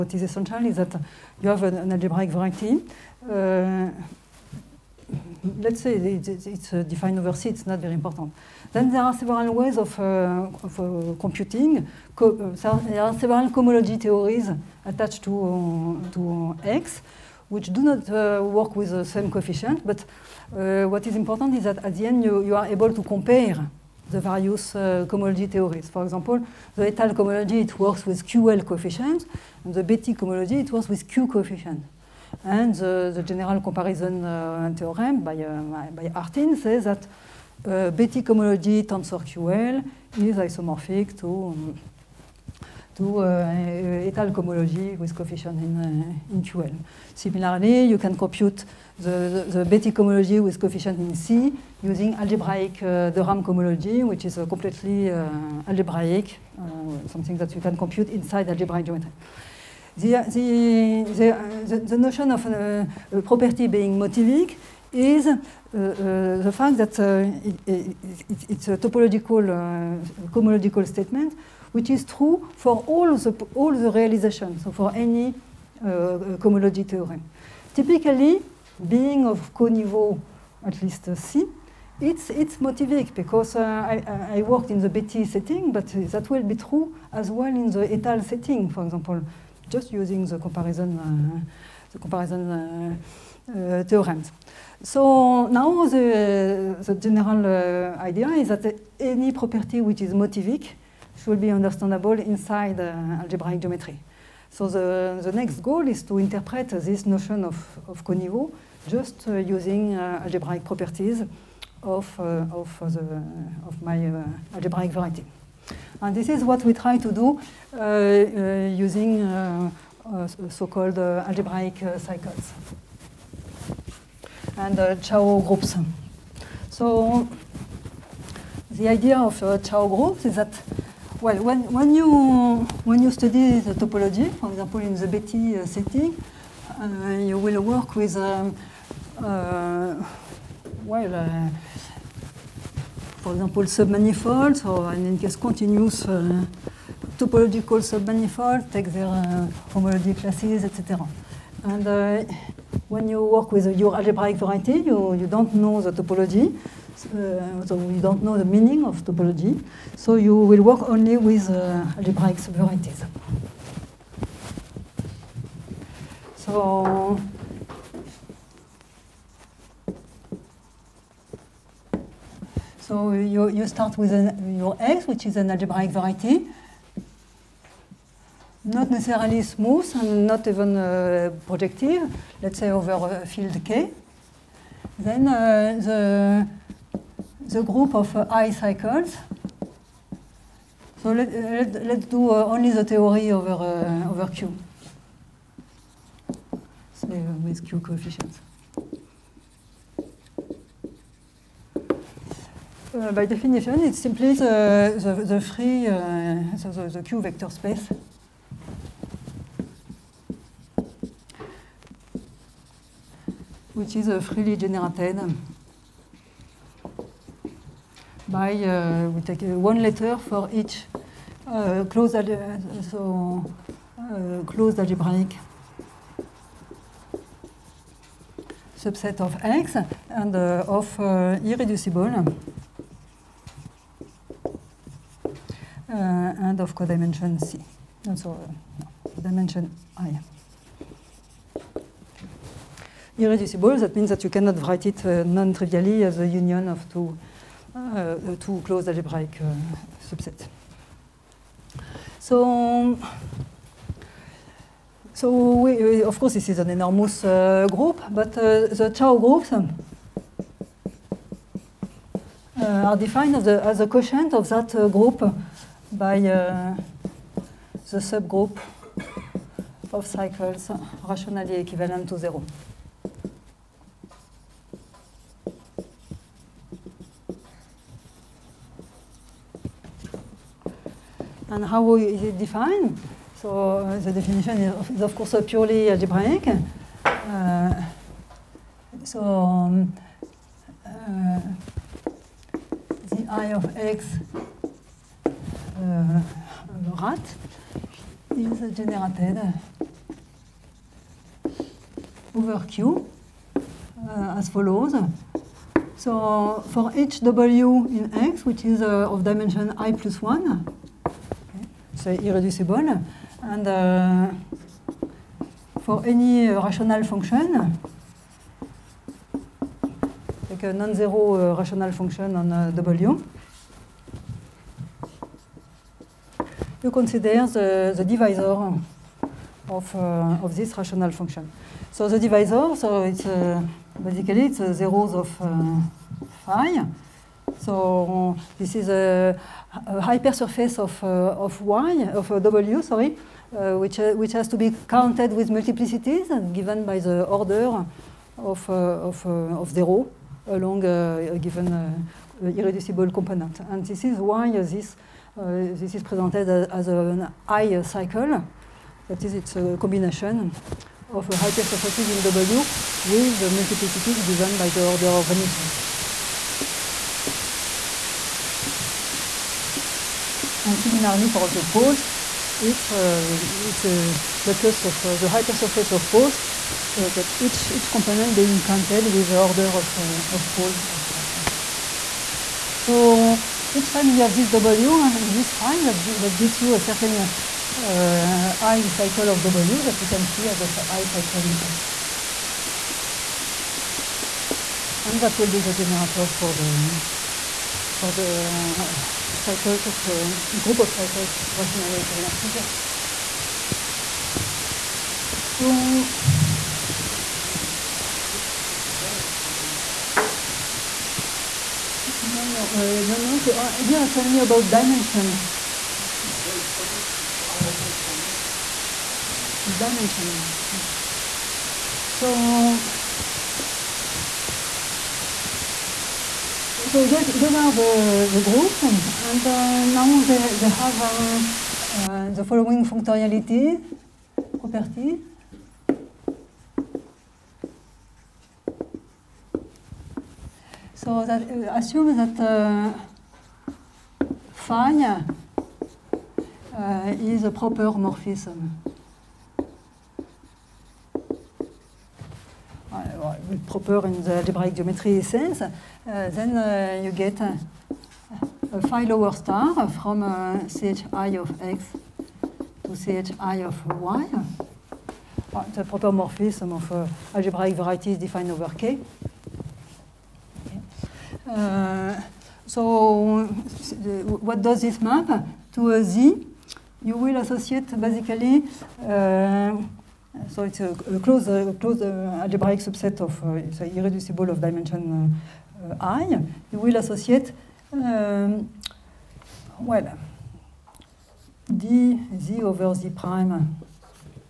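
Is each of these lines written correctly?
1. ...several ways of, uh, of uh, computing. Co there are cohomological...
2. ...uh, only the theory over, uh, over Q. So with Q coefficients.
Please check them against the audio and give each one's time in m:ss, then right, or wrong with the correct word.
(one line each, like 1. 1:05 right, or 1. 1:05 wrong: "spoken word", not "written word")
1. 0:09 wrong: "several", not "cohomological"
2. 3:12 right.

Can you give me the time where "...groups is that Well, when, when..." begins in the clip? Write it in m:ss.
2:09.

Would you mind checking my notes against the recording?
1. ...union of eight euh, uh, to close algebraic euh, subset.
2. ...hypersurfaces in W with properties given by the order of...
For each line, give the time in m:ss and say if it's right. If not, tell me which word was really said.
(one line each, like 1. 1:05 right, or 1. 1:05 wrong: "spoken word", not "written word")
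1. 4:06 wrong: "two", not "eight"
2. 6:01 wrong: "multiplicities", not "properties".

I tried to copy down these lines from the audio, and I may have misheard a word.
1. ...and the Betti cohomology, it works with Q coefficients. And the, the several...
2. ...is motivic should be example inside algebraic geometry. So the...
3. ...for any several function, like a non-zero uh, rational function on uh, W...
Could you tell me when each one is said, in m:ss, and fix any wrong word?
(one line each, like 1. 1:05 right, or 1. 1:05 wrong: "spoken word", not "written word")
1. 0:29 wrong: "general", not "several"
2. 1:40 wrong: "understandable", not "example"
3. 5:15 wrong: "rational", not "several".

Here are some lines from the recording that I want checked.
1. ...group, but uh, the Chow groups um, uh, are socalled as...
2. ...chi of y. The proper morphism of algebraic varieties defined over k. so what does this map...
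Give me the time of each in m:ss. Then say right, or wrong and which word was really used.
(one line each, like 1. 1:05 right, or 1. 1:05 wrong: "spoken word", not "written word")
1. 4:17 wrong: "defined", not "socalled"
2. 7:43 right.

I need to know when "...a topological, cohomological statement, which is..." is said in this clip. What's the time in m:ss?
1:08.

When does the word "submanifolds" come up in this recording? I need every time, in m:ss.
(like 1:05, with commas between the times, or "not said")
2:23, 2:27.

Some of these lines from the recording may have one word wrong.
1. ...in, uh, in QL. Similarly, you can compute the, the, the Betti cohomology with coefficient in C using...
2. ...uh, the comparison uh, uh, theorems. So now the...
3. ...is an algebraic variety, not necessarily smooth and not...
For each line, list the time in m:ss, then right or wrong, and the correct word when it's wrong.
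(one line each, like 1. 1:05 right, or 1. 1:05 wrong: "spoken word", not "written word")
1. 0:45 right
2. 1:30 right
3. 2:55 right.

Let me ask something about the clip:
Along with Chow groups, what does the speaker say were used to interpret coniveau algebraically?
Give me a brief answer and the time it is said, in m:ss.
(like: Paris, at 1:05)
algebraic cycles, at 2:00.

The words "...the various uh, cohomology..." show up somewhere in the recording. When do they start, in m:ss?
0:24.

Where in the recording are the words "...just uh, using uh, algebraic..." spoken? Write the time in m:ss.
1:48.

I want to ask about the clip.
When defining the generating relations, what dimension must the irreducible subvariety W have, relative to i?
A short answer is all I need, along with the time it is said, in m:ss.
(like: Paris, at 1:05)
i plus 1, at 5:09.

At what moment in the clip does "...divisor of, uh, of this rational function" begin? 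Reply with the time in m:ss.
5:28.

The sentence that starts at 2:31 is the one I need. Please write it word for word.
And when you work with your algebraic variety, you, you don't know the topology.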